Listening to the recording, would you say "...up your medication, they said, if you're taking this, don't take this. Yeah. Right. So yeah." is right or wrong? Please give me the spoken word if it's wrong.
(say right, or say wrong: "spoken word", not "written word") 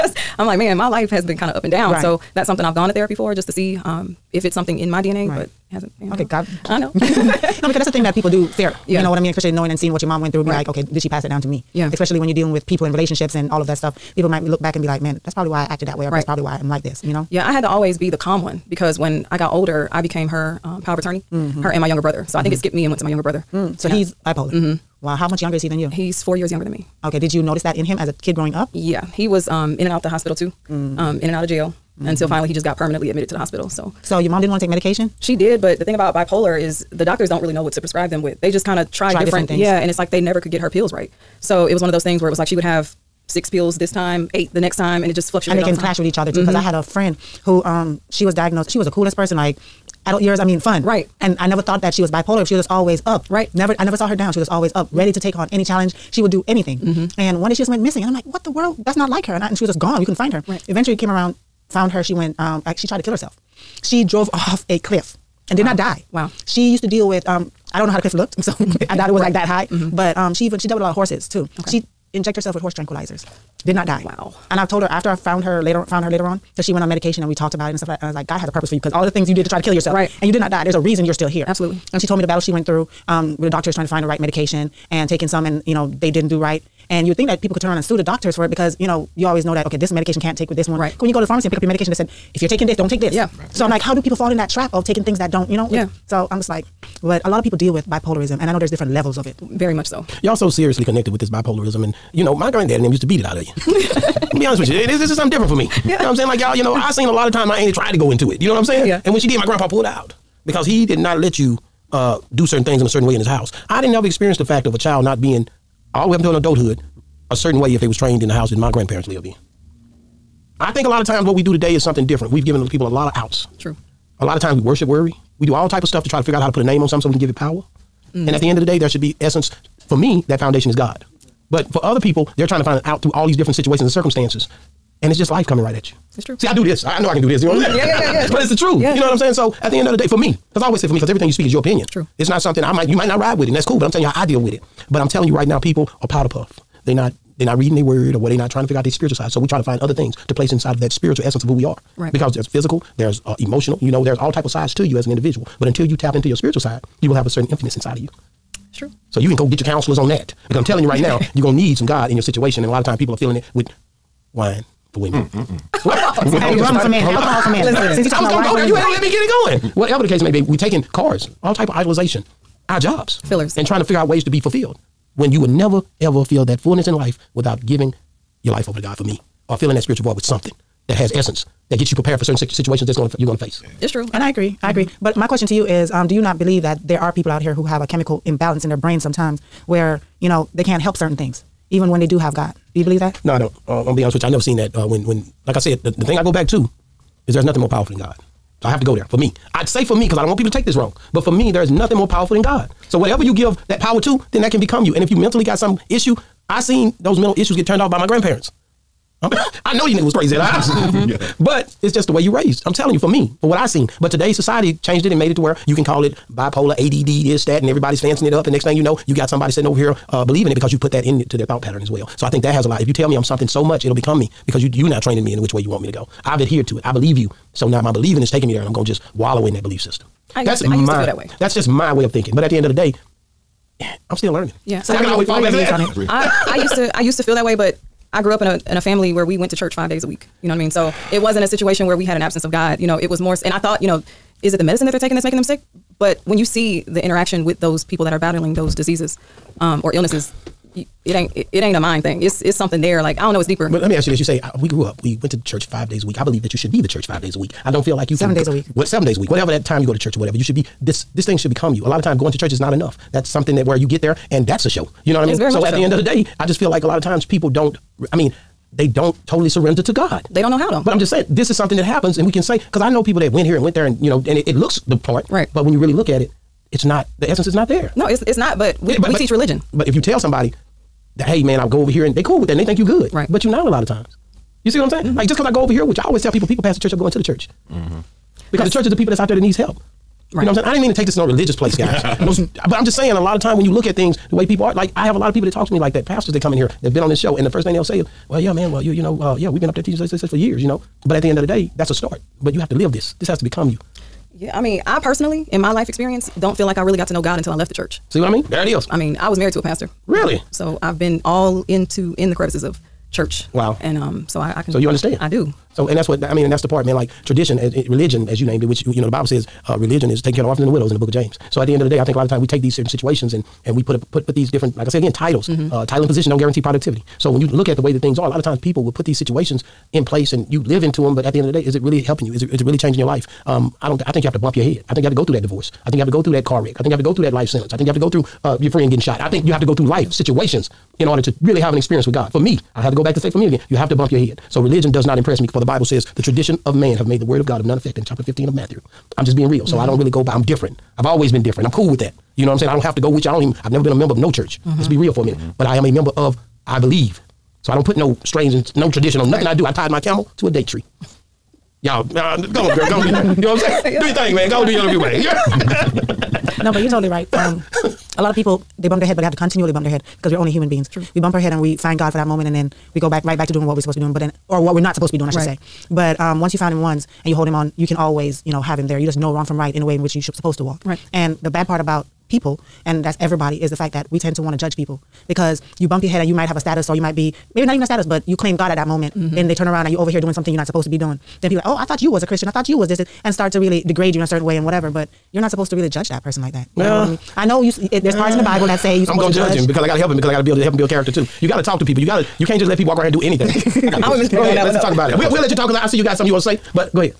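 right.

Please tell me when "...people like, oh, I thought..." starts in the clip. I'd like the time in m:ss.
6:31.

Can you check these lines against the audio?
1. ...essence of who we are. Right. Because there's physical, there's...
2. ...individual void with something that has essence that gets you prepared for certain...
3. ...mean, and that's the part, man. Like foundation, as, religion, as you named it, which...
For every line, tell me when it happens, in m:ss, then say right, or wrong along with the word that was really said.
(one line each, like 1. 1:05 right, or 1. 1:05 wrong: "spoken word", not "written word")
1. 2:31 right
2. 2:59 wrong: "spiritual", not "individual"
3. 5:16 wrong: "tradition", not "foundation".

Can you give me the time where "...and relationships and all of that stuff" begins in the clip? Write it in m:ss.
0:12.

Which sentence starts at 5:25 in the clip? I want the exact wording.
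uh, title and position don't guarantee productivity.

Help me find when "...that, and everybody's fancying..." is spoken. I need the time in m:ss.
3:37.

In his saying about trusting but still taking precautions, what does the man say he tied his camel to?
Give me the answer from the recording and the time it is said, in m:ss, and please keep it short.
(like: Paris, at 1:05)
a date tree, at 6:00.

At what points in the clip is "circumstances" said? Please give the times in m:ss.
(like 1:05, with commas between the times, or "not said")
2:13.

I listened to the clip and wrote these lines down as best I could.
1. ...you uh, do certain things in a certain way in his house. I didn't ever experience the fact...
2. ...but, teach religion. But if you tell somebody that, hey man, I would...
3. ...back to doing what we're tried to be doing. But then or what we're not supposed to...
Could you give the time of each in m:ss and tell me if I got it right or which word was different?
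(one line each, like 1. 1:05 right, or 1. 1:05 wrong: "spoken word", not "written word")
1. 1:51 right
2. 4:39 right
3. 6:13 wrong: "supposed", not "tried".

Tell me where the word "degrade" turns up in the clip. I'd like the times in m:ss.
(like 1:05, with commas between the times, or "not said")
6:33.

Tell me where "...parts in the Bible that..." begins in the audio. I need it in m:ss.
6:38.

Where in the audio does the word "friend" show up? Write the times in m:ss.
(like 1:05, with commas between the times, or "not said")
0:46, 5:38.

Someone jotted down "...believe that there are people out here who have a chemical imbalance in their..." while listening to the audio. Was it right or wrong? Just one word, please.
right.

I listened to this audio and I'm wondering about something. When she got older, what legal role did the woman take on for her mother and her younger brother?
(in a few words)
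power of attorney.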